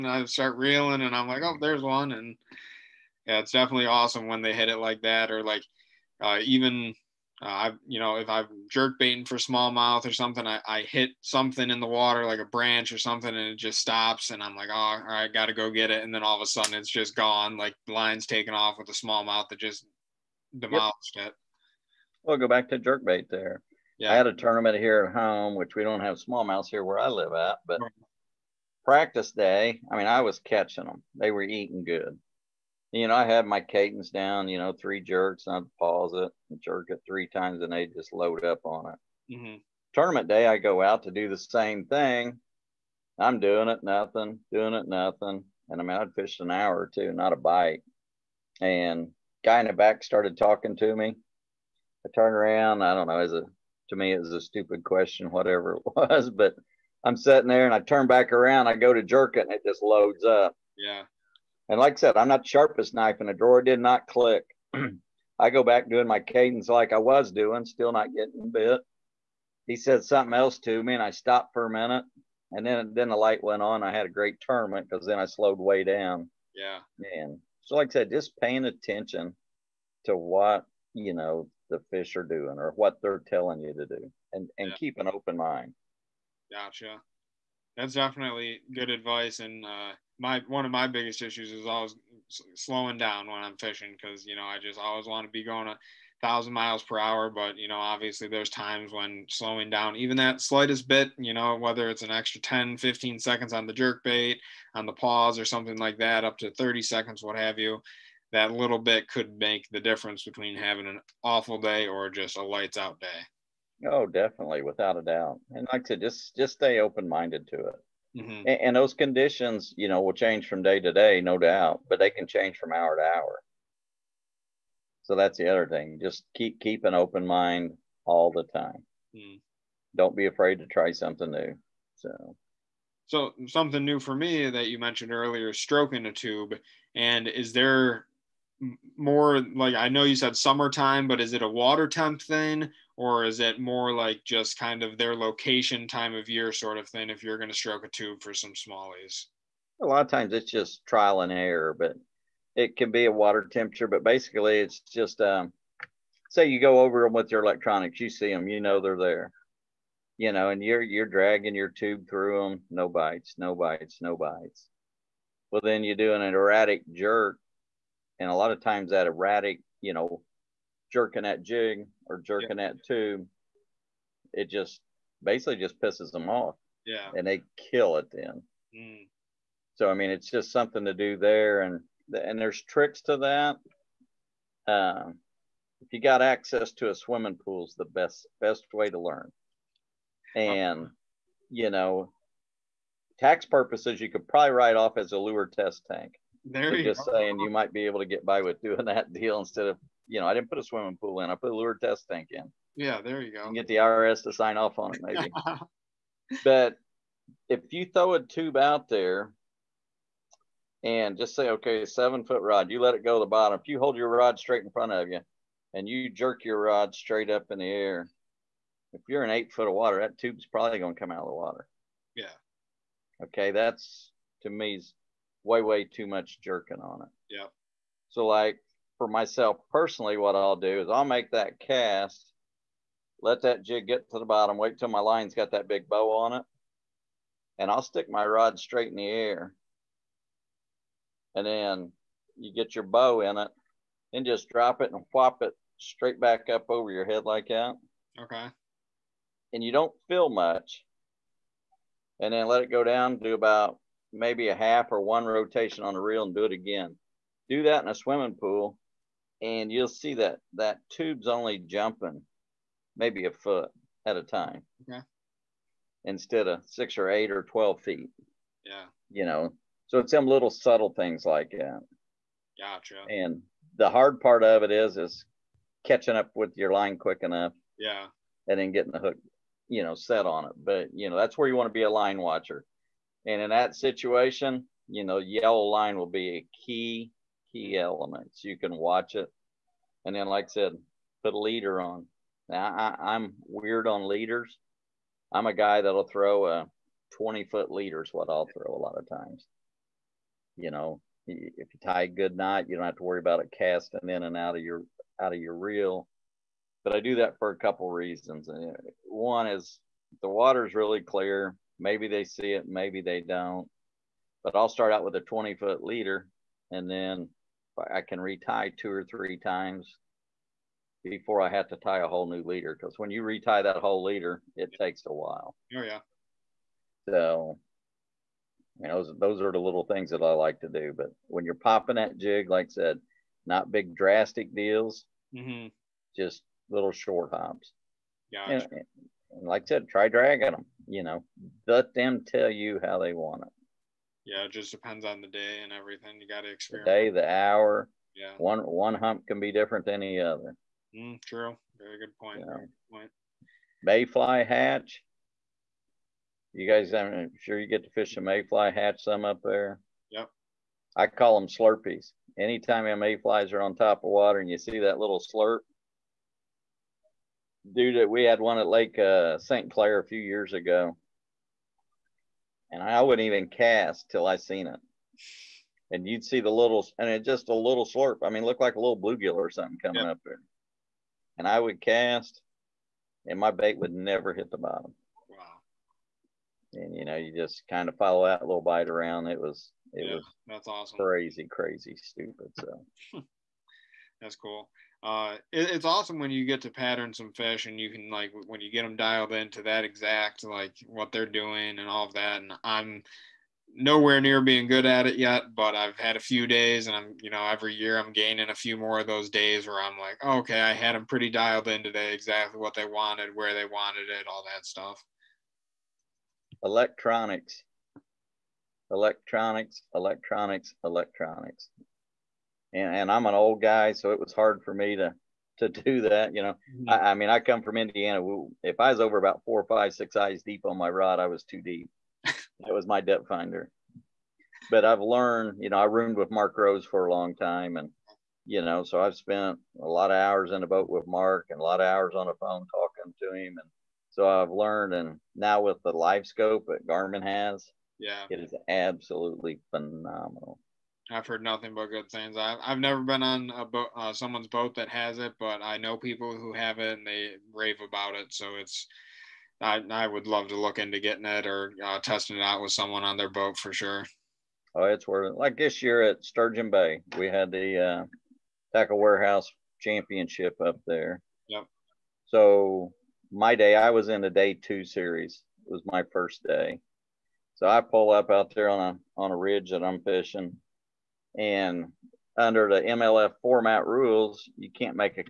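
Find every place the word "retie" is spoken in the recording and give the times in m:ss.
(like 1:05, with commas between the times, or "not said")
5:18, 5:23.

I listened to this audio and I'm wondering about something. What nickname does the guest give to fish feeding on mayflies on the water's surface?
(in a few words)
Slurpees.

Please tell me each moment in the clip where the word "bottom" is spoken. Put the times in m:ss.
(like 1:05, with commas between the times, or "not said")
3:33, 3:54, 6:24.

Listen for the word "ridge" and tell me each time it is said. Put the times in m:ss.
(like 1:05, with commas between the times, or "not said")
7:59.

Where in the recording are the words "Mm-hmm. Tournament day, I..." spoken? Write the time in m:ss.
0:39.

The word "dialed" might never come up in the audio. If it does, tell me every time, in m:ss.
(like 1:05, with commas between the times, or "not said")
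6:38, 6:51.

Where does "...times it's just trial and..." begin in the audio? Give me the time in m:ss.
2:30.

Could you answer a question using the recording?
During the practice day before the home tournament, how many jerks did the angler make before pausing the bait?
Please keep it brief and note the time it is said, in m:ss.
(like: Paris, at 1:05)
3, at 0:34.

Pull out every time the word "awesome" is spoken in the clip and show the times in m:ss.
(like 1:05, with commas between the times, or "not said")
0:03, 6:30, 6:35.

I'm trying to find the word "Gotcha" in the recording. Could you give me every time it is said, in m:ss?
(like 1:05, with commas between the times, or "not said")
1:26, 4:32, 5:38.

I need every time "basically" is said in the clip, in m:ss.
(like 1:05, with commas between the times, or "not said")
2:34, 2:55.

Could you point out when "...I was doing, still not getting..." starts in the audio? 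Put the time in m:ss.
1:06.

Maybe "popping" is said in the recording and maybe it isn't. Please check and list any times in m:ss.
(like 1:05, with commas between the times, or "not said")
5:31.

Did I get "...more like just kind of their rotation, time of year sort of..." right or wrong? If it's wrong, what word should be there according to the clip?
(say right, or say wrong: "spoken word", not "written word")
wrong: "location", not "rotation".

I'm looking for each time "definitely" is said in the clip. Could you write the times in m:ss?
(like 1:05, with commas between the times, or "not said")
0:03, 1:27, 1:54.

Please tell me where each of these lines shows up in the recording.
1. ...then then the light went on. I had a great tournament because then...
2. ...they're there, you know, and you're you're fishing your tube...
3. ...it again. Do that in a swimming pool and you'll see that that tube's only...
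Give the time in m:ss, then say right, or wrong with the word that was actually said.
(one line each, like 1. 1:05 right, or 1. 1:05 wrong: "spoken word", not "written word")
1. 1:12 right
2. 2:38 wrong: "dragging", not "fishing"
3. 4:16 right.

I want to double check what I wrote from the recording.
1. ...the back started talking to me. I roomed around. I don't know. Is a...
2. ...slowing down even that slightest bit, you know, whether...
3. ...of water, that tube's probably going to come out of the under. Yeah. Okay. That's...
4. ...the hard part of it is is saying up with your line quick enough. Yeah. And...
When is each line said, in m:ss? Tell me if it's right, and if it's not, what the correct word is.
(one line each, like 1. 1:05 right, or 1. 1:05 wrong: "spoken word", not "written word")
1. 0:49 wrong: "turned", not "roomed"
2. 1:39 right
3. 3:39 wrong: "water", not "under"
4. 4:33 wrong: "catching", not "saying".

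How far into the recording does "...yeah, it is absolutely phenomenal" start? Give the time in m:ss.
7:27.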